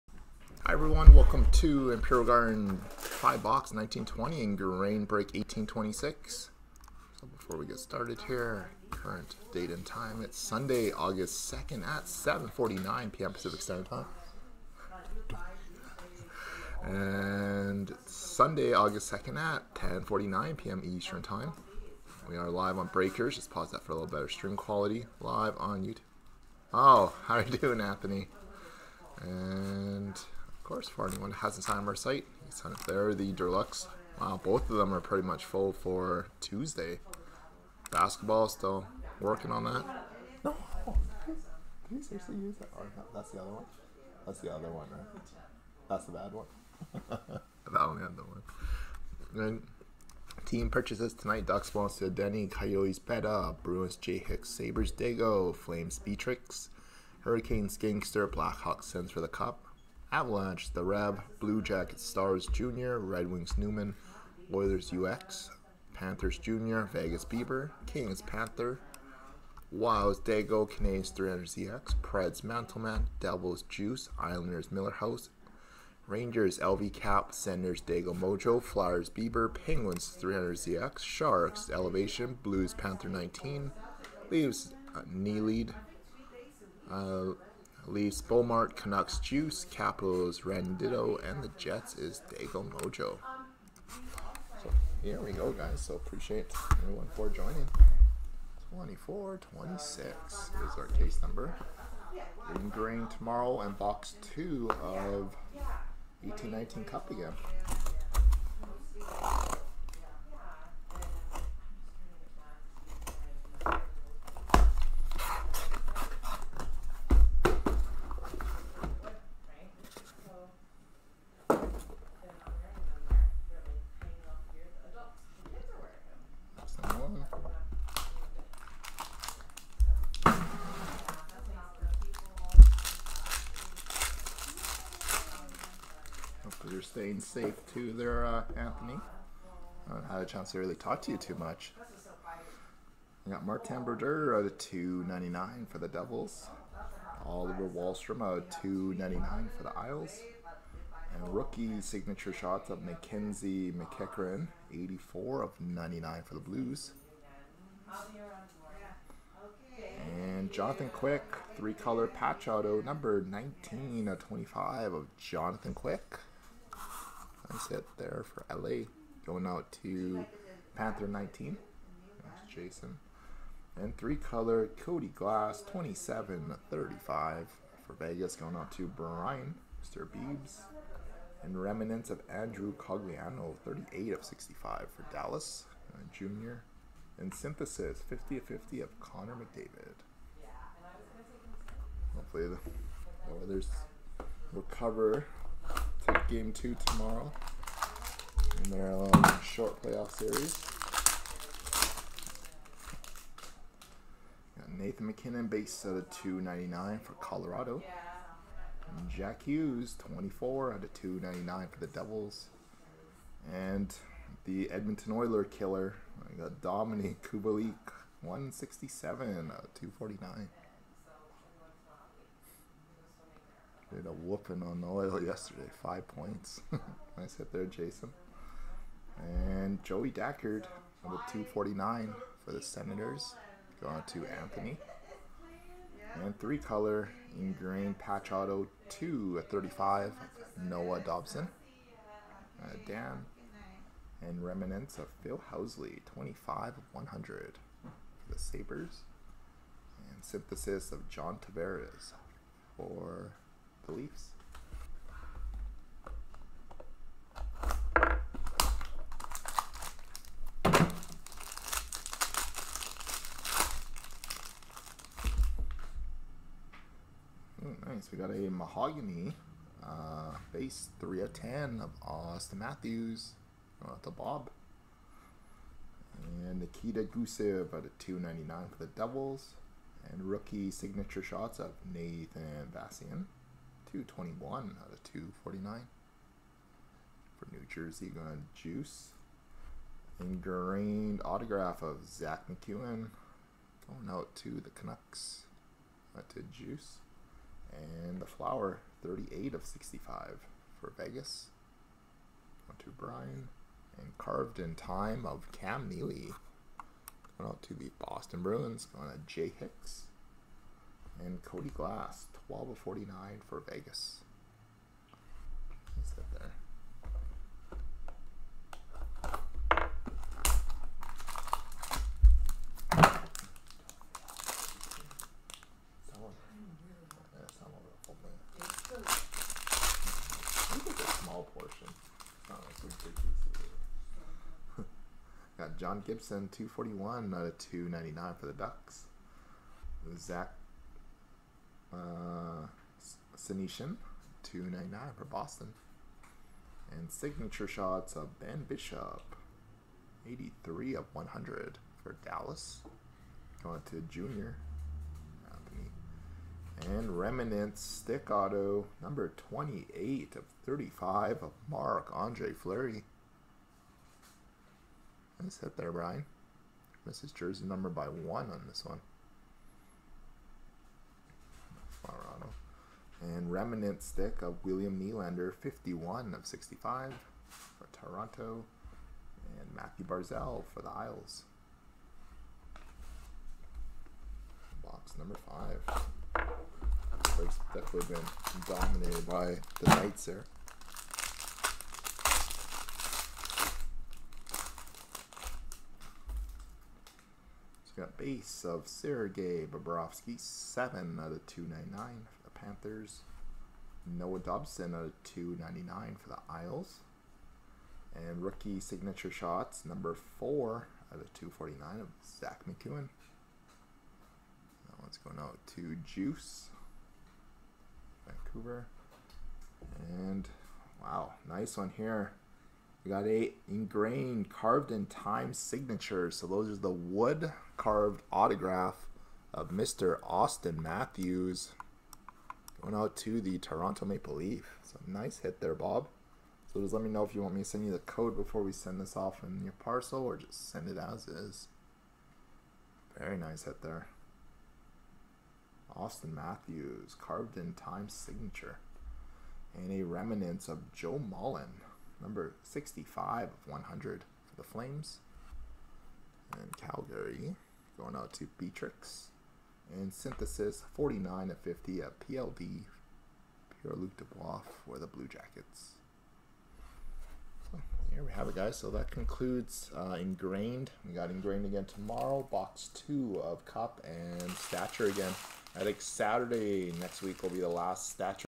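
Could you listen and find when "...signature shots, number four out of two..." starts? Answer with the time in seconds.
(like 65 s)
408 s.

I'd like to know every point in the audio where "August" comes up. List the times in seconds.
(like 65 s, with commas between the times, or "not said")
10 s, 18 s.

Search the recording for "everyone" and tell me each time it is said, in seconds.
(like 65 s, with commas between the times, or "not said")
0 s, 96 s.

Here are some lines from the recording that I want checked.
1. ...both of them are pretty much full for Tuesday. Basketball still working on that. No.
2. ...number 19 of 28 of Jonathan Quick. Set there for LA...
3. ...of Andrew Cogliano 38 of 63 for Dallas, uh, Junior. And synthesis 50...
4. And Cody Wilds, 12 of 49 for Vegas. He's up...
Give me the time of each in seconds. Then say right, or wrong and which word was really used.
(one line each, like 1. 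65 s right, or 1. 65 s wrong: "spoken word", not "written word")
1. 34 s right
2. 162 s wrong: "25", not "28"
3. 182 s wrong: "65", not "63"
4. 311 s wrong: "Glass", not "Wilds".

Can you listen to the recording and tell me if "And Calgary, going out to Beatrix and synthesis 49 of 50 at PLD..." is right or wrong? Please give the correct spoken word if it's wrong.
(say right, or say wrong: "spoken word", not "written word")
right.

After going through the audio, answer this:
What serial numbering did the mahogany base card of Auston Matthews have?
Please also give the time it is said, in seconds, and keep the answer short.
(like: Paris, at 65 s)
3 of 10, at 270 s.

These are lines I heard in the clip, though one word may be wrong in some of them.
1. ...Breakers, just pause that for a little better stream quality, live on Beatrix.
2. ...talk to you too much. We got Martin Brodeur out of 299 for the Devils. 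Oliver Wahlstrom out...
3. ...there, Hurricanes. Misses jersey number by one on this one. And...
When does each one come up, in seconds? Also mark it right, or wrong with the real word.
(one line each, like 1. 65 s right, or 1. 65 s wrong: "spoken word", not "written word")
1. 22 s wrong: "YouTube", not "Beatrix"
2. 140 s right
3. 365 s wrong: "Brian", not "Hurricanes".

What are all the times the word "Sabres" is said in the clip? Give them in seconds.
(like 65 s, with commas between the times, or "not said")
54 s, 248 s.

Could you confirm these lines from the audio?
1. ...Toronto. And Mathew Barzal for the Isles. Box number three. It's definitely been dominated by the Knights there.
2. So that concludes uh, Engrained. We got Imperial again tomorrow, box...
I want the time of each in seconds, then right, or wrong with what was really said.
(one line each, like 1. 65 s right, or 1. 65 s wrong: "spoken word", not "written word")
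1. 377 s wrong: "five", not "three"
2. 468 s wrong: "Engrained", not "Imperial".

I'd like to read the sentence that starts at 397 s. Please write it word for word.
So got base of Sergei Bobrovsky, 7 out of 299 Panthers.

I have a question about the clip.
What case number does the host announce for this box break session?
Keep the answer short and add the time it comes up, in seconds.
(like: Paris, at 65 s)
2426, at 98 s.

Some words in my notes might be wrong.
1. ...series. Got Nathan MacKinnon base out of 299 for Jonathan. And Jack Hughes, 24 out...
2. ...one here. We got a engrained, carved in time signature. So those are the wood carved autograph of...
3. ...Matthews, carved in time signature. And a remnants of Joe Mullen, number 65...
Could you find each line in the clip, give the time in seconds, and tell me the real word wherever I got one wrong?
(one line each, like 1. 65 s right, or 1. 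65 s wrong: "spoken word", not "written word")
1. 200 s wrong: "Colorado", not "Jonathan"
2. 421 s right
3. 446 s right.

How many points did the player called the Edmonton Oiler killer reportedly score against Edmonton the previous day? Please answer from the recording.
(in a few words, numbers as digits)
5.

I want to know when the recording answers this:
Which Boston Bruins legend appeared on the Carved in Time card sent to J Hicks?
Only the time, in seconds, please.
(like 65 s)
305 s.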